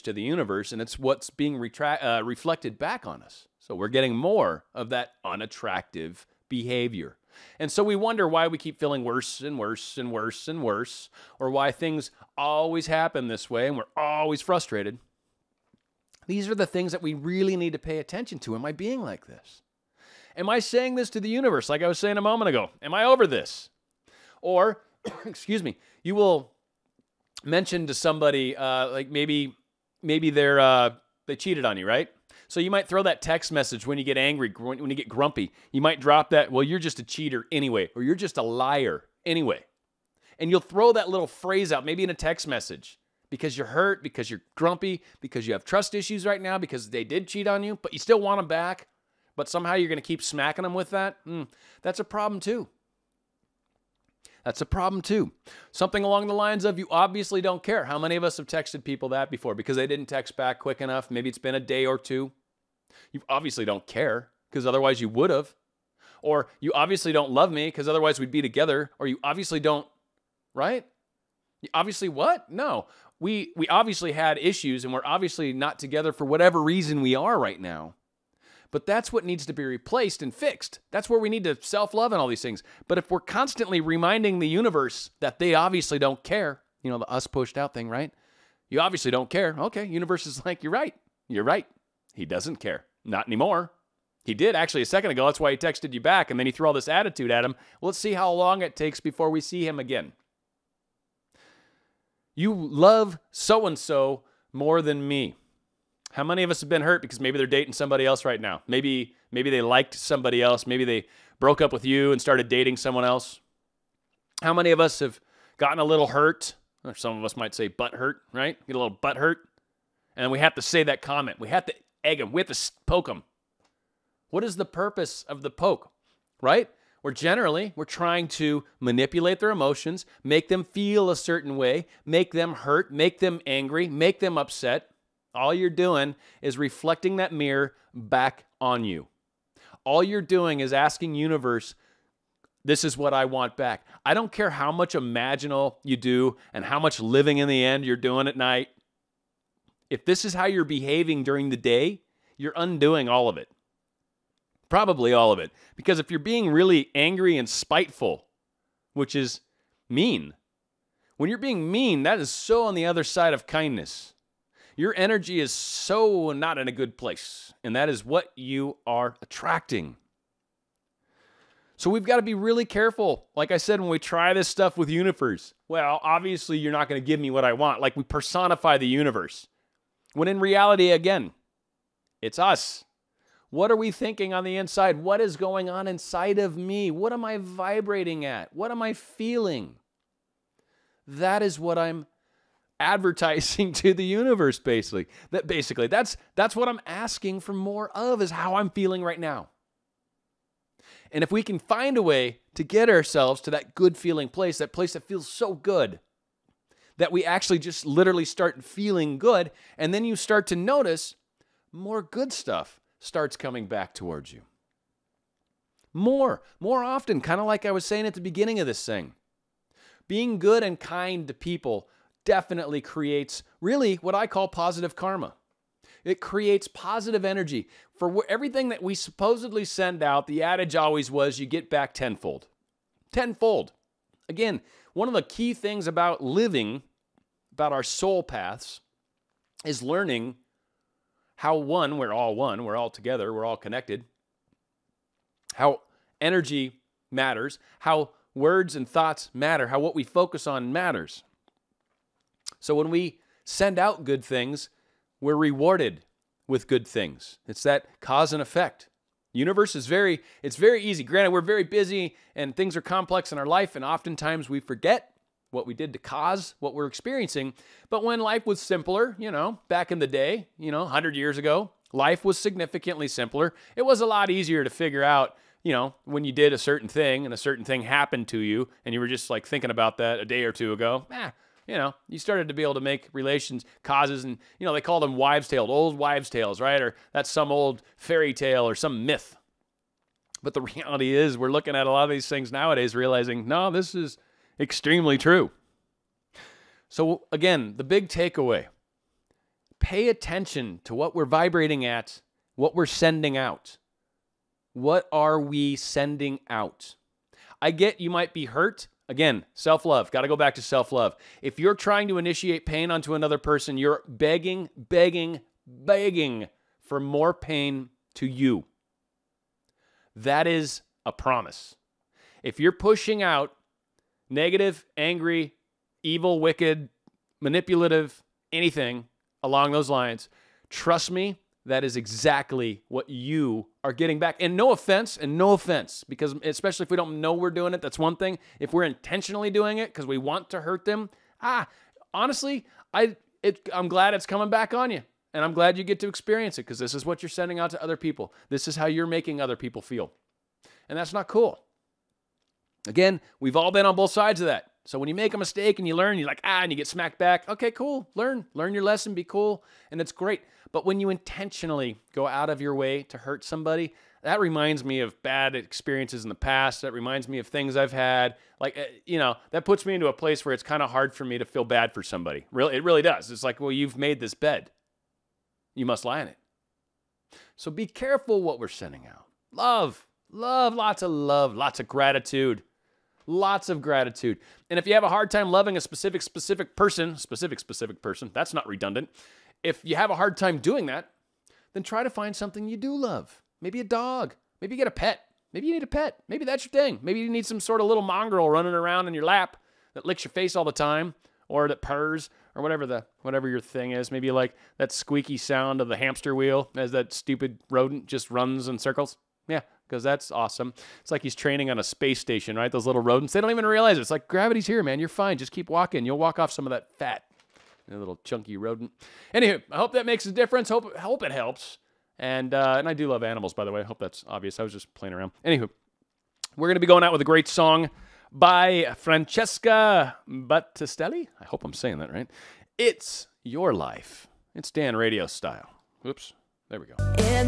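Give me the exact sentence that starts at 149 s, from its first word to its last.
If this is how you're behaving during the day, you're undoing all of it.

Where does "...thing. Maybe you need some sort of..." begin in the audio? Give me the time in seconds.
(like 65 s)
396 s.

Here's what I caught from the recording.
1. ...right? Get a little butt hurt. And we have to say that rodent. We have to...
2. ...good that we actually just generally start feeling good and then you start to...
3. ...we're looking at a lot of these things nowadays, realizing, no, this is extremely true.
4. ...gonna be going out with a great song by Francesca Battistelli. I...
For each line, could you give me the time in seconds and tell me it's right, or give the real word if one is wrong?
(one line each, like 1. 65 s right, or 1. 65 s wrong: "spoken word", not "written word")
1. 118 s wrong: "comment", not "rodent"
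2. 205 s wrong: "literally", not "generally"
3. 291 s right
4. 426 s right.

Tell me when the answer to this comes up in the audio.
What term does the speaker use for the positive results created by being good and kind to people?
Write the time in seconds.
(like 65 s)
224 s.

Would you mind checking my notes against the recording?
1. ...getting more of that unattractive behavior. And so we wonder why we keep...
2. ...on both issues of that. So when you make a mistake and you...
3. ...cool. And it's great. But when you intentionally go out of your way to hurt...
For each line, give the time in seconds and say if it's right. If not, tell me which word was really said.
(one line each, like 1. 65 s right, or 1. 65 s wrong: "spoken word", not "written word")
1. 3 s right
2. 353 s wrong: "sides", not "issues"
3. 359 s right.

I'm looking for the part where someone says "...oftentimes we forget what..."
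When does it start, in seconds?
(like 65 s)
263 s.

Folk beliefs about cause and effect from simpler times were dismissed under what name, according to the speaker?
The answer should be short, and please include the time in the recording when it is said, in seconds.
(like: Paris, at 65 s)
old wives' tales, at 285 s.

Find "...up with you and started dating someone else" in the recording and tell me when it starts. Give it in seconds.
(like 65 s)
111 s.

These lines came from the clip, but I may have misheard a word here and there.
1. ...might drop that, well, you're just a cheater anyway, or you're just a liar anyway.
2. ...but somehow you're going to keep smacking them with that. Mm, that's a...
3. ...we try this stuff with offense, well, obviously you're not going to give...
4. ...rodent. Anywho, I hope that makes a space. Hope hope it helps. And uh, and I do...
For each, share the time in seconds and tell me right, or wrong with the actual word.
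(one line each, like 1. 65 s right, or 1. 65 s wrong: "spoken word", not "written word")
1. 35 s right
2. 49 s right
3. 173 s wrong: "universe", not "offense"
4. 418 s wrong: "difference", not "space".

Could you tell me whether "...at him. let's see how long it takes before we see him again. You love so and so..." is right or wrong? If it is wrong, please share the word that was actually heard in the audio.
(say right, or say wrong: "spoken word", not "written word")
right.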